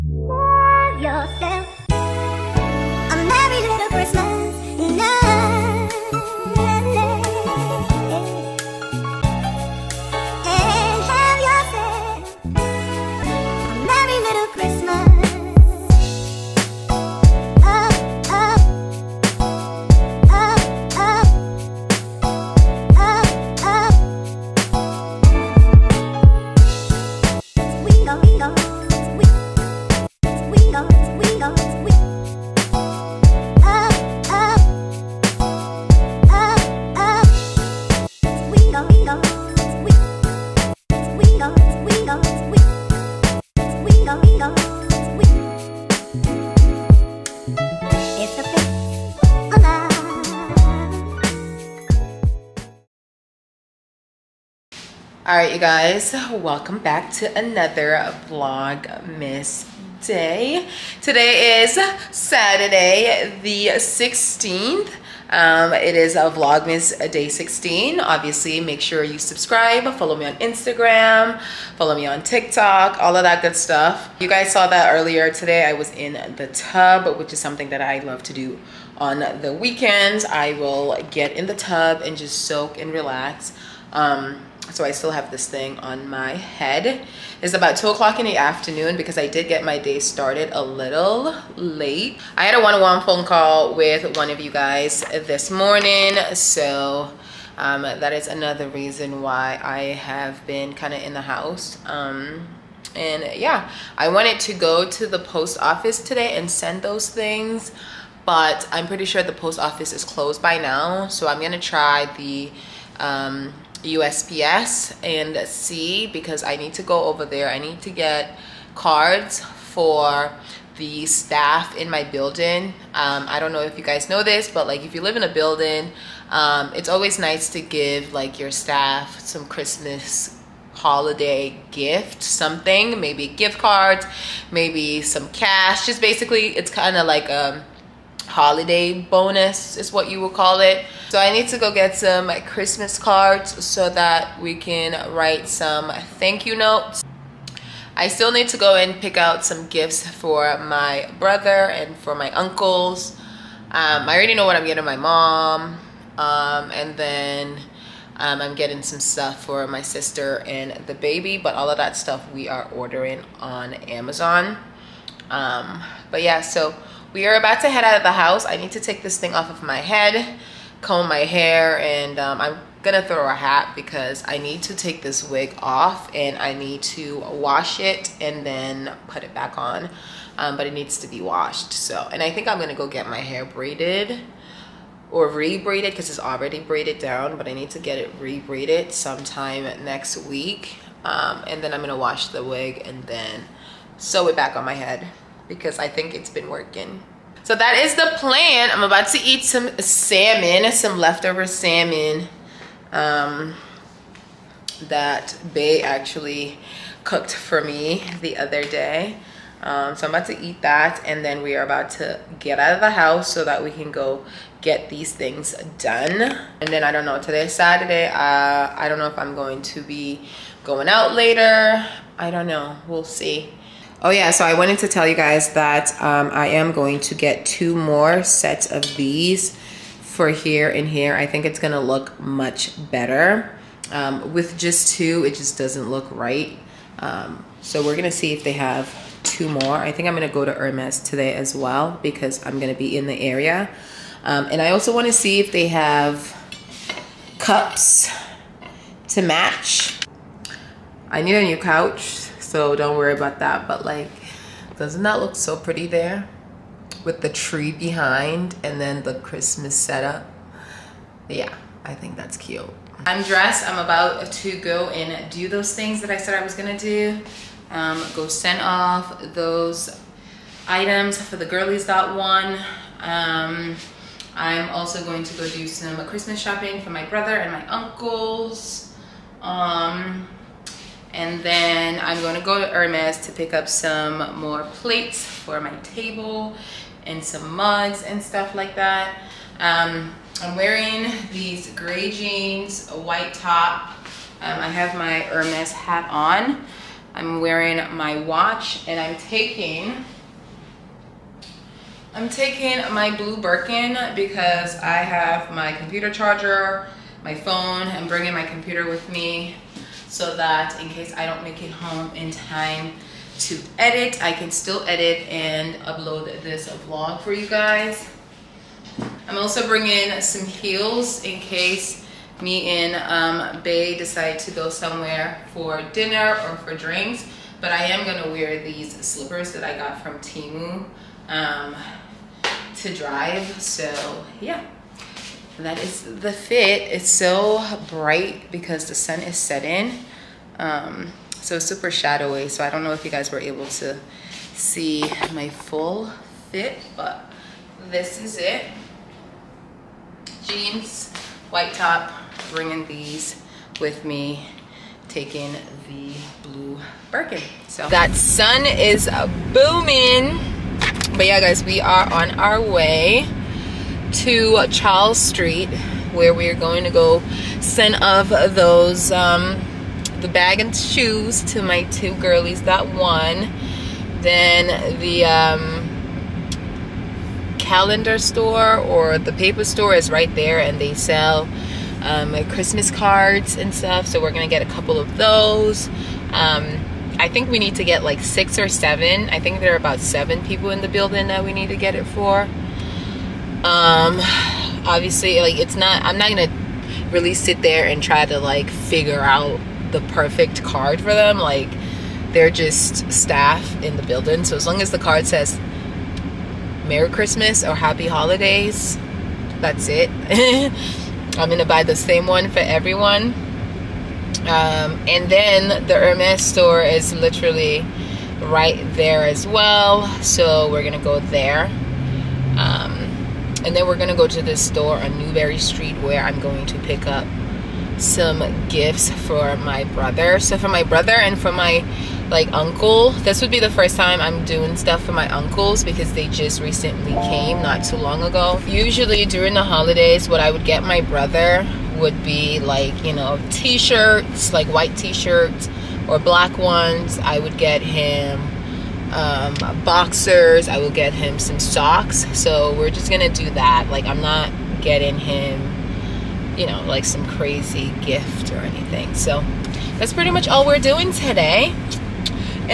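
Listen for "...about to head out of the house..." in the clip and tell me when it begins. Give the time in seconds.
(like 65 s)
167 s.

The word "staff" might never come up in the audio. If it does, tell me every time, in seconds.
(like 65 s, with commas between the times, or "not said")
121 s, 128 s, 403 s.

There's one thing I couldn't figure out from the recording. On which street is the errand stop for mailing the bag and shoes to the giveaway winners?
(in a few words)
Charles Street.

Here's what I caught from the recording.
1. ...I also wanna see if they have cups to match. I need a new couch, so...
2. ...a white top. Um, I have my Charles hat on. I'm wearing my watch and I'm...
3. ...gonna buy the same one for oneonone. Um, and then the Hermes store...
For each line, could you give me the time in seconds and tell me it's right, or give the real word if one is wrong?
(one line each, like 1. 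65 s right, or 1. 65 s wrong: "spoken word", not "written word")
1. 244 s right
2. 292 s wrong: "Hermes", not "Charles"
3. 411 s wrong: "everyone", not "oneonone".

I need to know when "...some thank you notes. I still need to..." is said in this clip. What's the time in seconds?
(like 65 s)
145 s.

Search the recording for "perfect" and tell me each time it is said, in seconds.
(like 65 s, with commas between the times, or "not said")
400 s.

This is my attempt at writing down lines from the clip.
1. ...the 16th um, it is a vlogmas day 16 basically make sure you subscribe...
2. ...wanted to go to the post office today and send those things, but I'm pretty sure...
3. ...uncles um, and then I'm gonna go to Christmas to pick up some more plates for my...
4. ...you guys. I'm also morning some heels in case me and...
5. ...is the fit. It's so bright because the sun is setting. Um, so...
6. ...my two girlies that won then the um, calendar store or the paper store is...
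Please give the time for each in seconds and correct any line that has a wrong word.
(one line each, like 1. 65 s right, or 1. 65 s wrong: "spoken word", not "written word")
1. 63 s wrong: "obviously", not "basically"
2. 104 s right
3. 277 s wrong: "Hermes", not "Christmas"
4. 317 s wrong: "bringing", not "morning"
5. 335 s right
6. 371 s right.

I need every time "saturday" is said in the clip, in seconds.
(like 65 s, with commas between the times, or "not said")
62 s, 217 s.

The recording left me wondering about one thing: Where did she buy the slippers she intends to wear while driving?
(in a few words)
Temu.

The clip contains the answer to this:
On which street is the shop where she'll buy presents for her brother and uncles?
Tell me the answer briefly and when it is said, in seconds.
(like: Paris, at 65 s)
Newbury Street, at 425 s.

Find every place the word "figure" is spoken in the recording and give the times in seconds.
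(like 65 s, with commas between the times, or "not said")
398 s.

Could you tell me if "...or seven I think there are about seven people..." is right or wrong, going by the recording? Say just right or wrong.
right.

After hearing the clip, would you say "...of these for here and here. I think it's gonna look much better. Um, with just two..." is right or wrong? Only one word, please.
right.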